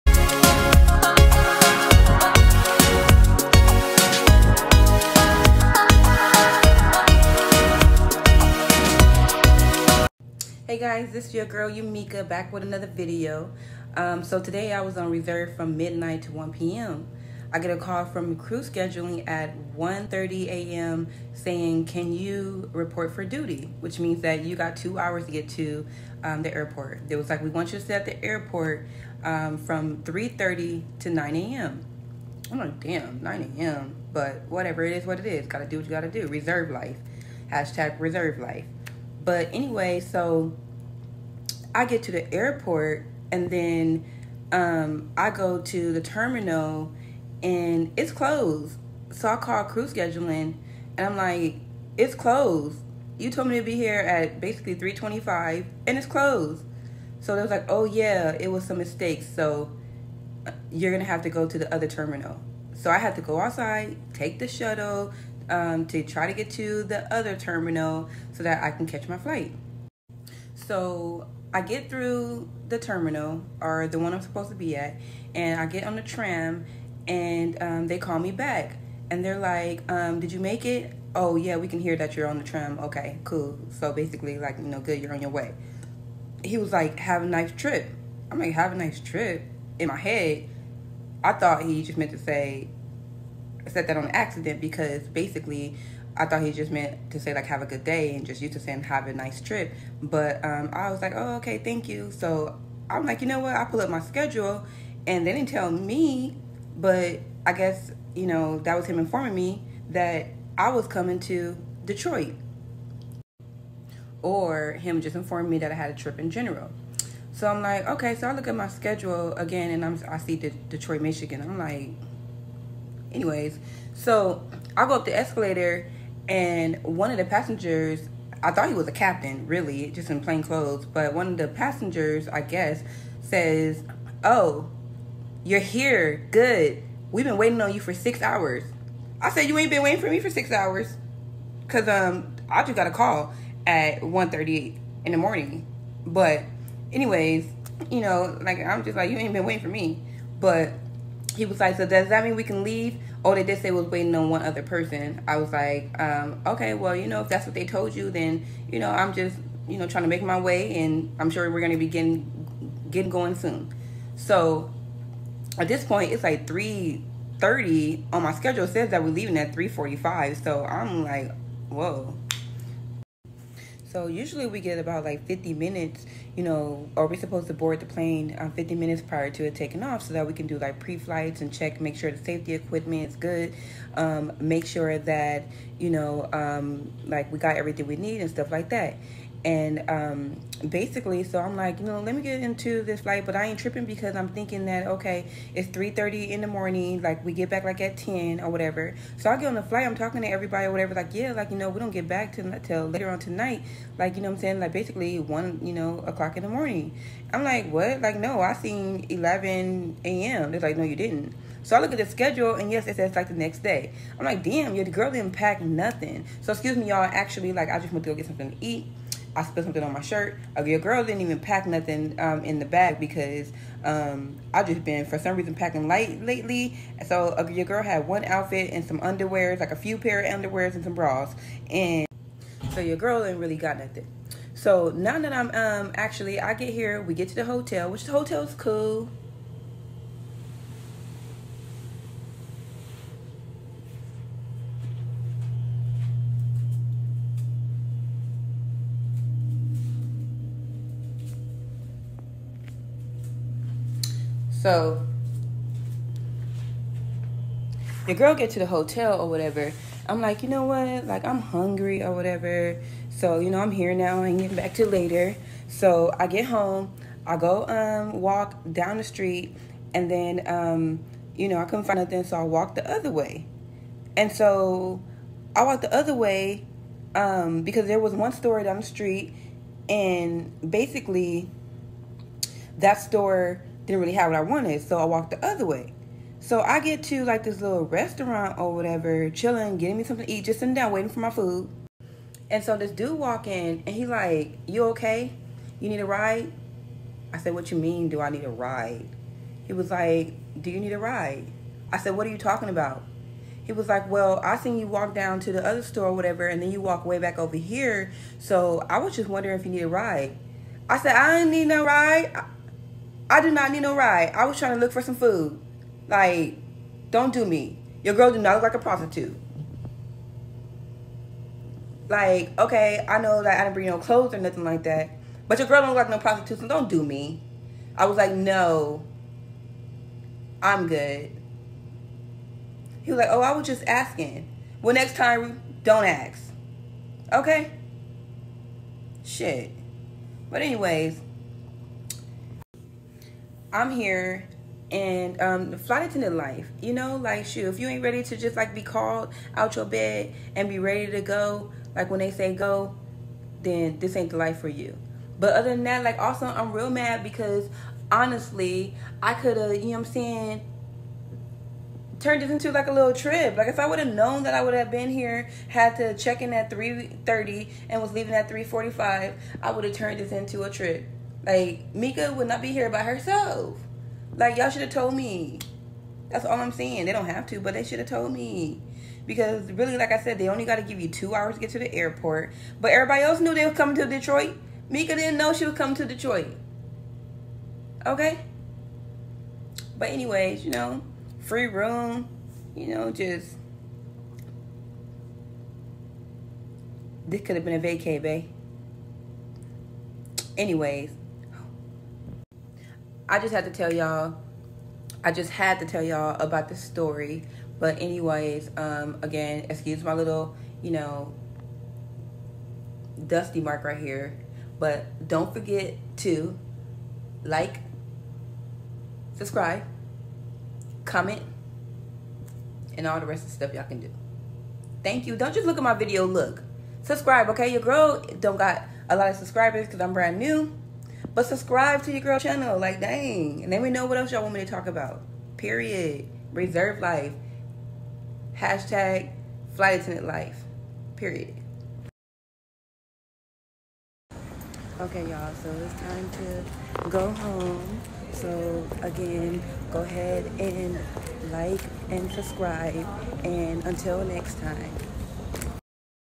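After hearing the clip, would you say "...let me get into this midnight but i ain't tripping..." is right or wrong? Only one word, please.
wrong.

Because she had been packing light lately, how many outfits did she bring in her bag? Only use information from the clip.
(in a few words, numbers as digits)
1.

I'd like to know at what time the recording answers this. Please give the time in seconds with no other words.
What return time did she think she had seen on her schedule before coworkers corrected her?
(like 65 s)
209 s.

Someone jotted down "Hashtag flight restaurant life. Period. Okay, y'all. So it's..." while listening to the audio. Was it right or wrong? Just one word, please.
wrong.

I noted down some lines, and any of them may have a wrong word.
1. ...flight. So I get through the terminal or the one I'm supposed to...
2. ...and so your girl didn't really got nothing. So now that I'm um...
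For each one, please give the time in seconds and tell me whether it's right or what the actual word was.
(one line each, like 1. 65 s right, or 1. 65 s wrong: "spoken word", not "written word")
1. 69 s right
2. 231 s right.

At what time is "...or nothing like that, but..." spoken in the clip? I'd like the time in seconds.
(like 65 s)
324 s.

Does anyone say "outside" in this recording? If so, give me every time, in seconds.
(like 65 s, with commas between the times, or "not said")
63 s.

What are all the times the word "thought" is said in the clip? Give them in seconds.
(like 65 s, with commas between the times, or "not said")
91 s, 96 s, 128 s.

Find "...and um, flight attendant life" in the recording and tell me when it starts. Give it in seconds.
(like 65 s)
344 s.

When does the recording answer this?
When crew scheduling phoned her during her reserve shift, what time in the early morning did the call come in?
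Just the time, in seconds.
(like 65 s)
19 s.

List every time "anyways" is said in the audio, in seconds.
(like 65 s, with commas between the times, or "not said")
39 s, 123 s, 146 s, 340 s, 390 s, 400 s, 408 s.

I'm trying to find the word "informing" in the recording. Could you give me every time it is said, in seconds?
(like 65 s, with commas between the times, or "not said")
108 s, 115 s.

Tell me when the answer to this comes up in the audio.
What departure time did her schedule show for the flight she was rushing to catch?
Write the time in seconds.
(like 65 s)
169 s.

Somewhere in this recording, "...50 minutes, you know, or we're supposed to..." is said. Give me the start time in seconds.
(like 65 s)
175 s.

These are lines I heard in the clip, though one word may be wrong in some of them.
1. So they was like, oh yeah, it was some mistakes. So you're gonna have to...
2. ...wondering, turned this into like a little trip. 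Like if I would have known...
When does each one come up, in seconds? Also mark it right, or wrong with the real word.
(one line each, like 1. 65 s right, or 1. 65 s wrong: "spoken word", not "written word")
1. 57 s right
2. 360 s wrong: "saying", not "wondering".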